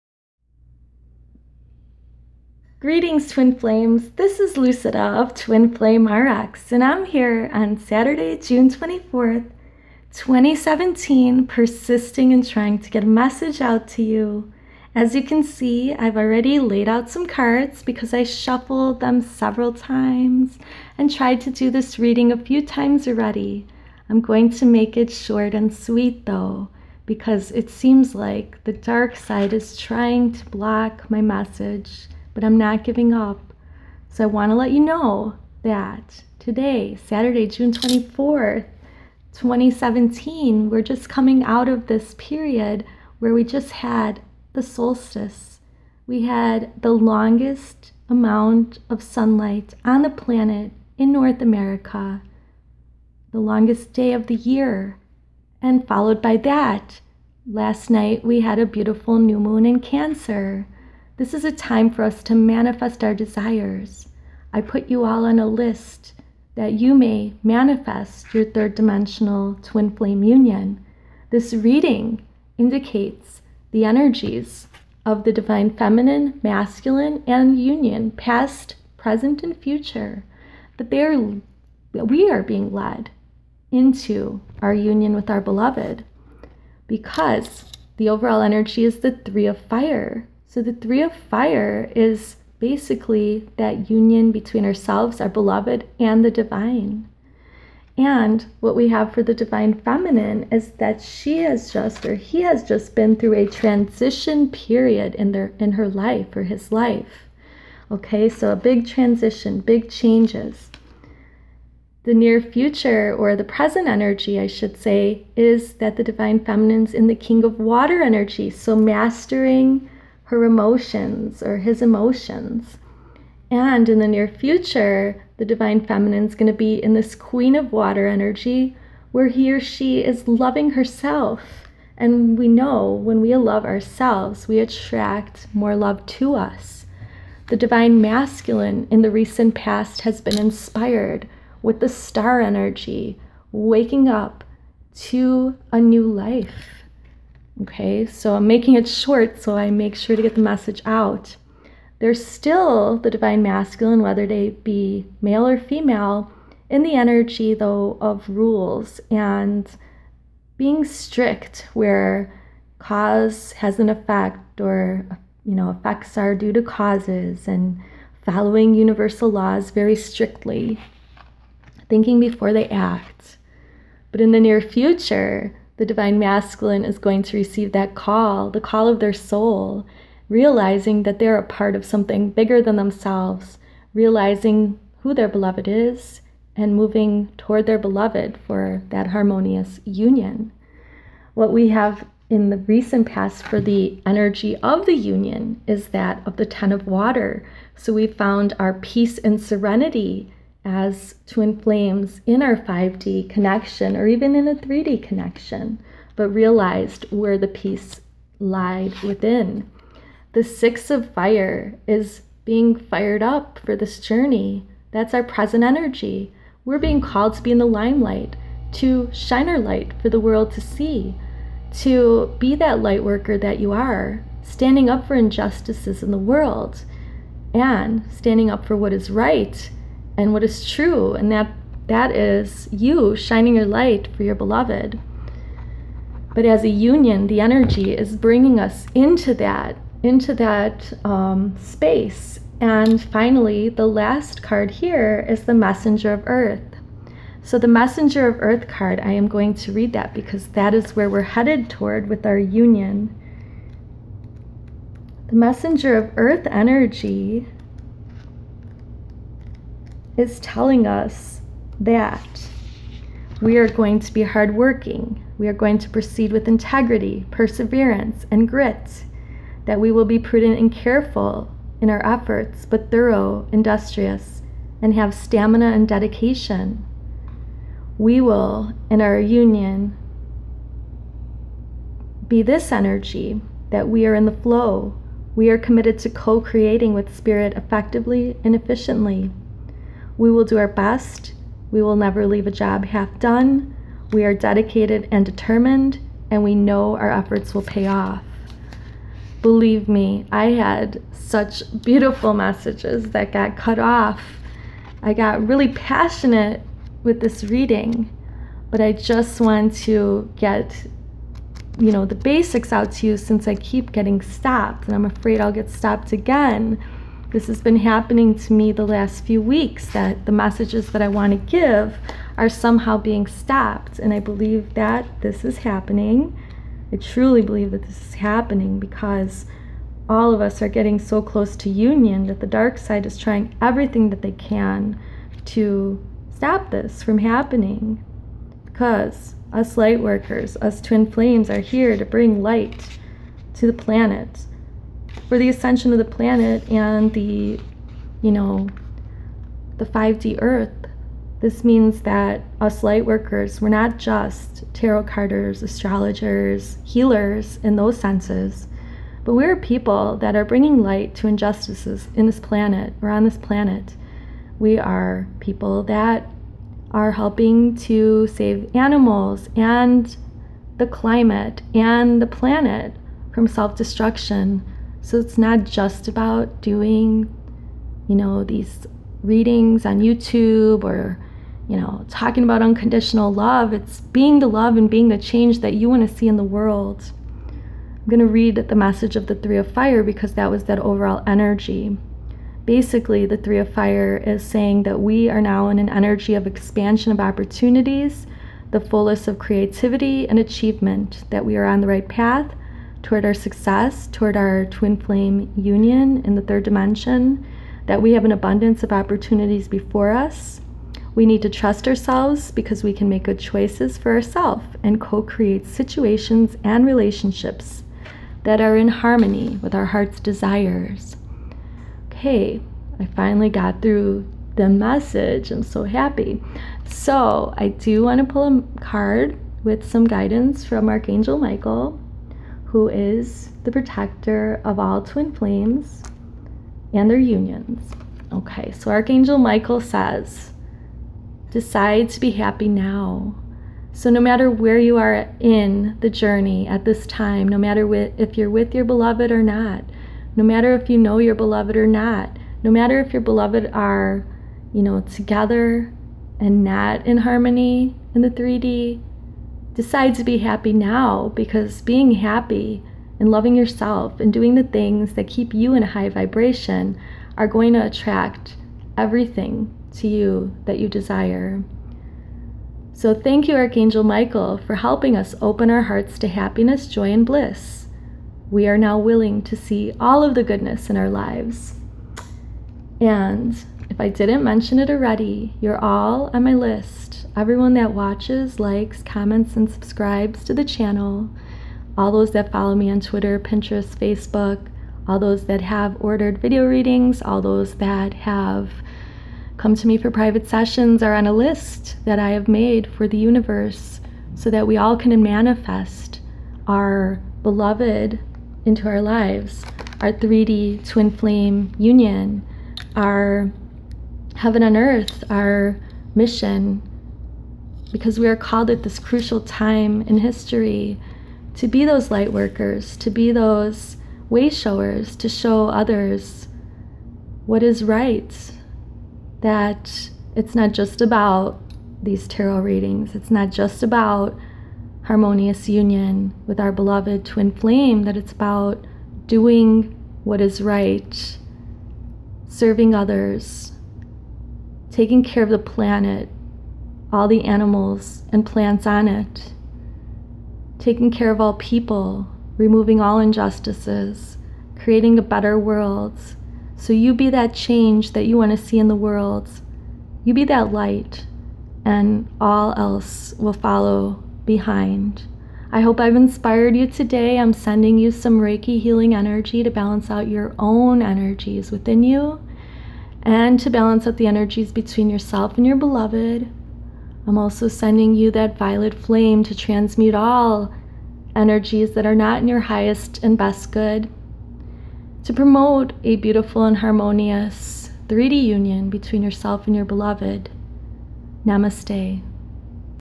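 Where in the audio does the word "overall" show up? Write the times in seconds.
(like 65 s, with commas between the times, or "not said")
88 s, 390 s.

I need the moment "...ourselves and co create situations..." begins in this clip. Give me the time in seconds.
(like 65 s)
414 s.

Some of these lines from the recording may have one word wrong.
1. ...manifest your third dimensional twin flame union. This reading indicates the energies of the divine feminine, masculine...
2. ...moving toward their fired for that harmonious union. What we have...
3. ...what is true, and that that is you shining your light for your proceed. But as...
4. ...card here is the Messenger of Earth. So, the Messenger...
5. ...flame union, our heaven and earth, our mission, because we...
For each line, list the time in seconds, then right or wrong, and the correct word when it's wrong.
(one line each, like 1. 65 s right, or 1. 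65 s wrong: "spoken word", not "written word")
1. 67 s right
2. 186 s wrong: "beloved", not "fired"
3. 230 s wrong: "beloved", not "proceed"
4. 244 s right
5. 511 s right.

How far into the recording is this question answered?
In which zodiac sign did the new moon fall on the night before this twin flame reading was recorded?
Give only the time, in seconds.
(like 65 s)
59 s.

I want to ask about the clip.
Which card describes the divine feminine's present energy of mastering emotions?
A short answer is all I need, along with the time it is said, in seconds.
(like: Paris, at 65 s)
King of Water, at 117 s.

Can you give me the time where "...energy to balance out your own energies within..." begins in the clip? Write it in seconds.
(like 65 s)
569 s.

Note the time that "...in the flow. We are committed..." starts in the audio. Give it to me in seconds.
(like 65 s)
284 s.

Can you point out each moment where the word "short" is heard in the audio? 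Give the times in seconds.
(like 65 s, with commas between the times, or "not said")
25 s, 148 s.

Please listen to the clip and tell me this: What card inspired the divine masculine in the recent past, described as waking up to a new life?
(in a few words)
The Star.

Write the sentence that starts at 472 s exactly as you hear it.
So, thank you, Archangel Michael, for helping us open our hearts to happiness, joy, and bliss.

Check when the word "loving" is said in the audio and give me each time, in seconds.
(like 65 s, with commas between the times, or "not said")
130 s, 463 s.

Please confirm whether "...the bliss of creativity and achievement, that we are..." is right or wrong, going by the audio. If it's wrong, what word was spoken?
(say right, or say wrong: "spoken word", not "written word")
wrong: "fullness", not "bliss".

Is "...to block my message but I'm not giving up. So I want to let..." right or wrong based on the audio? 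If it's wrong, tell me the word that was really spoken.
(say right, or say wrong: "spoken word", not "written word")
right.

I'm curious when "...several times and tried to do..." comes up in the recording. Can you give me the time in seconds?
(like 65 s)
19 s.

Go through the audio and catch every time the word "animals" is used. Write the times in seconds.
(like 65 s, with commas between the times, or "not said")
368 s, 547 s.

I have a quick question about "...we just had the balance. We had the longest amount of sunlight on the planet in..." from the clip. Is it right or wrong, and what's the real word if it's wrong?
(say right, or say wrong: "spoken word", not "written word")
wrong: "solstice", not "balance".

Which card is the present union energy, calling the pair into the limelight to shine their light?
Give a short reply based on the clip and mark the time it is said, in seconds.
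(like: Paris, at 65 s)
Six of Fire, at 210 s.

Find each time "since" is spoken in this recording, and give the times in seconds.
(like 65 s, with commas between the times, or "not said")
313 s.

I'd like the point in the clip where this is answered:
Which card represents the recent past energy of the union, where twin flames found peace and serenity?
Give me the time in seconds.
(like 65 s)
196 s.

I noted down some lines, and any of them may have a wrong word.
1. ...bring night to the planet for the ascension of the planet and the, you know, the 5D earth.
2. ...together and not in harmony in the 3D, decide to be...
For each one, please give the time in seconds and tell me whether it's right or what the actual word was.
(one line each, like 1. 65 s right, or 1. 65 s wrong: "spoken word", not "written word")
1. 342 s wrong: "light", not "night"
2. 455 s right.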